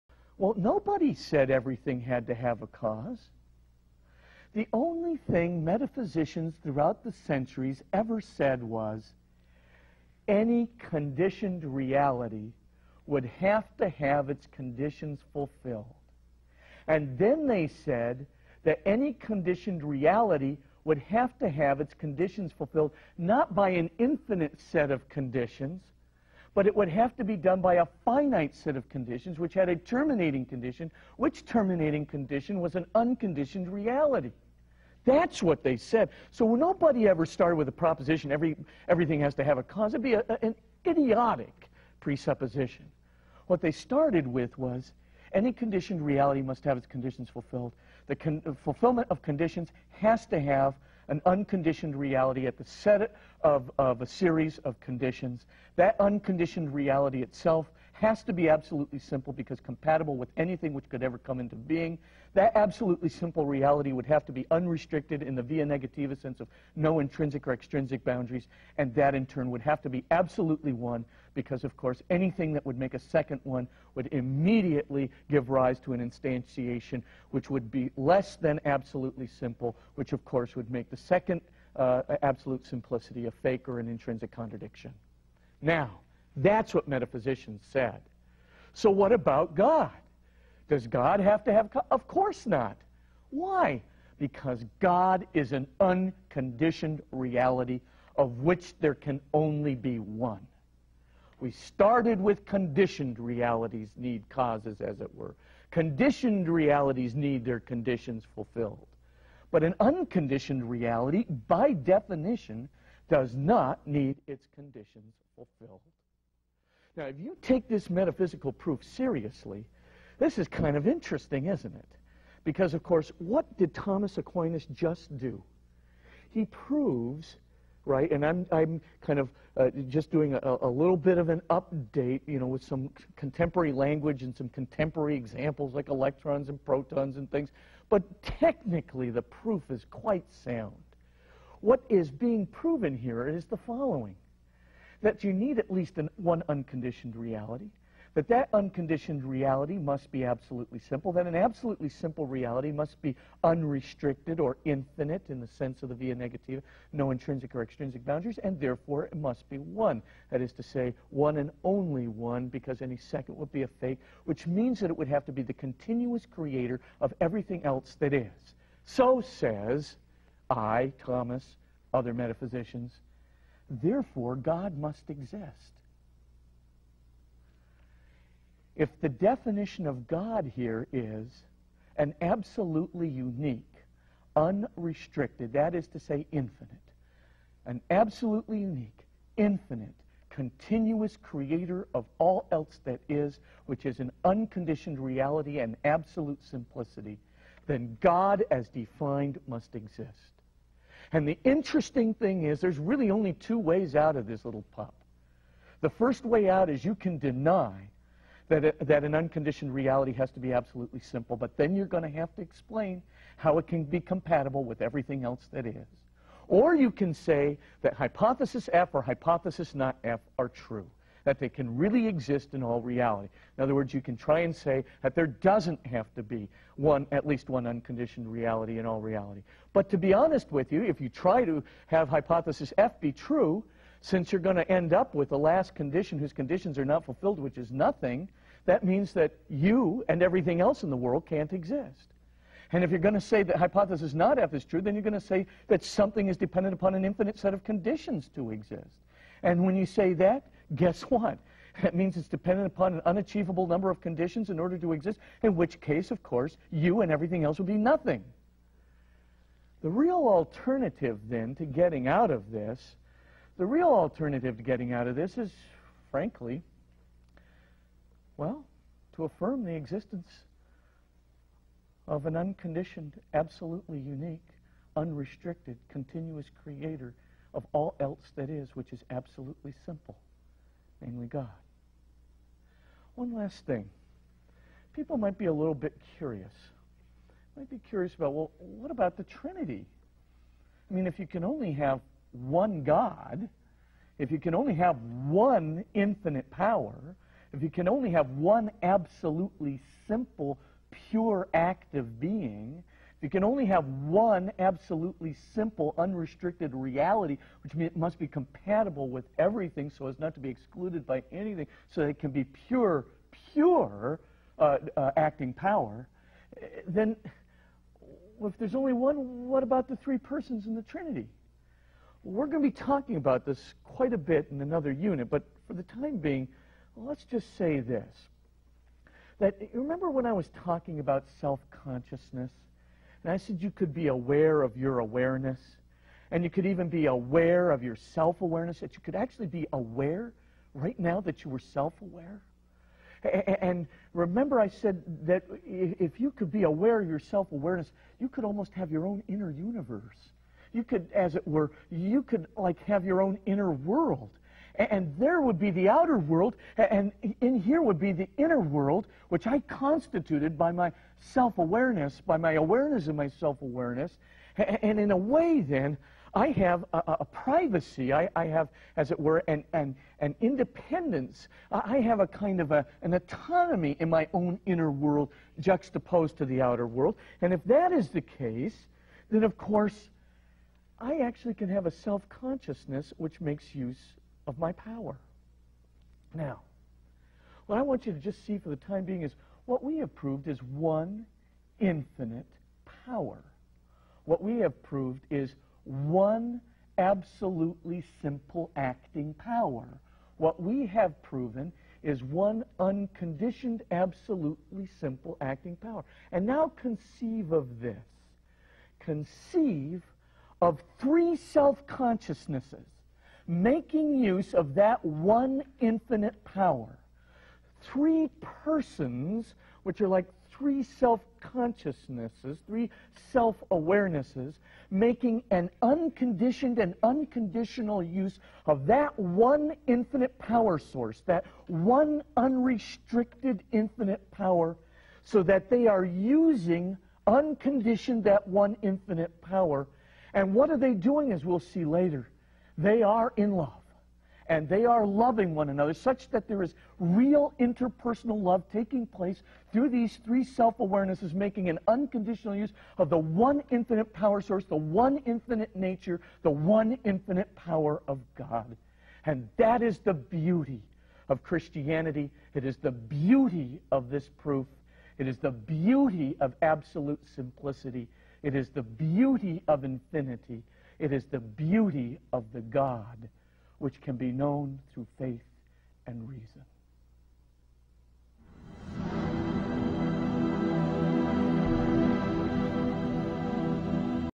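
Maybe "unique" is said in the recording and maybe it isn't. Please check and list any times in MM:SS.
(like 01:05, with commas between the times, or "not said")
03:03, 03:08, 04:33.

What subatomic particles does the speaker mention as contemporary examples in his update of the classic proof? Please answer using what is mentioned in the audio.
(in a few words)
electrons and protons.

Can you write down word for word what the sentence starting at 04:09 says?
And when you say that, guess what?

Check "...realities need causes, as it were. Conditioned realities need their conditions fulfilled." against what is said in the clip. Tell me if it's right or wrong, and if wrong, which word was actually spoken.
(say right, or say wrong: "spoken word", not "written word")
right.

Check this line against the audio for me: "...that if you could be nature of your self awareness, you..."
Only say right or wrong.
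wrong.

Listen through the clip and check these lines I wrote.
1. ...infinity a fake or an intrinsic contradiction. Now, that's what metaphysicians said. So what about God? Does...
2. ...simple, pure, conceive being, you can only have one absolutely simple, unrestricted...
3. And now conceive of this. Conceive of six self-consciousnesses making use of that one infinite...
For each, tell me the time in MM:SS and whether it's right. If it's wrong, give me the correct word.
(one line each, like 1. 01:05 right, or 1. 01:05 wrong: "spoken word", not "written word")
1. 01:22 wrong: "simplicity", not "infinity"
2. 05:00 wrong: "active", not "conceive"
3. 06:46 wrong: "three", not "six".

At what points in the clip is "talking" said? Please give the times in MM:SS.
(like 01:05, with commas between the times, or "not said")
05:22, 05:30.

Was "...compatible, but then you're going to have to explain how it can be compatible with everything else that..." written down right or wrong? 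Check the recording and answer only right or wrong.
wrong.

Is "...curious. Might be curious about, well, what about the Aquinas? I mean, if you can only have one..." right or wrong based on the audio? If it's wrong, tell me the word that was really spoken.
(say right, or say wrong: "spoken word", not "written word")
wrong: "Trinity", not "Aquinas".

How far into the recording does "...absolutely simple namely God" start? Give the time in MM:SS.
04:39.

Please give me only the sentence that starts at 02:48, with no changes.
So says I, Thomas, other metaphysicians, Therefore, God must exist.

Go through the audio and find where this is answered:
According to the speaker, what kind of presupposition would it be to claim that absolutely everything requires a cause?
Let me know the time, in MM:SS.
00:40.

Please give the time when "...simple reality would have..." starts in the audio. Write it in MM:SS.
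01:03.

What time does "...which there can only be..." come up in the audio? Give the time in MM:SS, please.
01:38.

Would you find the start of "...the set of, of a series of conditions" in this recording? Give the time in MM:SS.
00:52.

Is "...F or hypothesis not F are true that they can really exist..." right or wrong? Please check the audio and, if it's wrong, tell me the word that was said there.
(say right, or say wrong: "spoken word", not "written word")
right.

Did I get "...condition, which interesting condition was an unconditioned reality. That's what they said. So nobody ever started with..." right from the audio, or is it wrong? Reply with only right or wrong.
wrong.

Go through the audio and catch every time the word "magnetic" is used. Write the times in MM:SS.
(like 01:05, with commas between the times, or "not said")
not said.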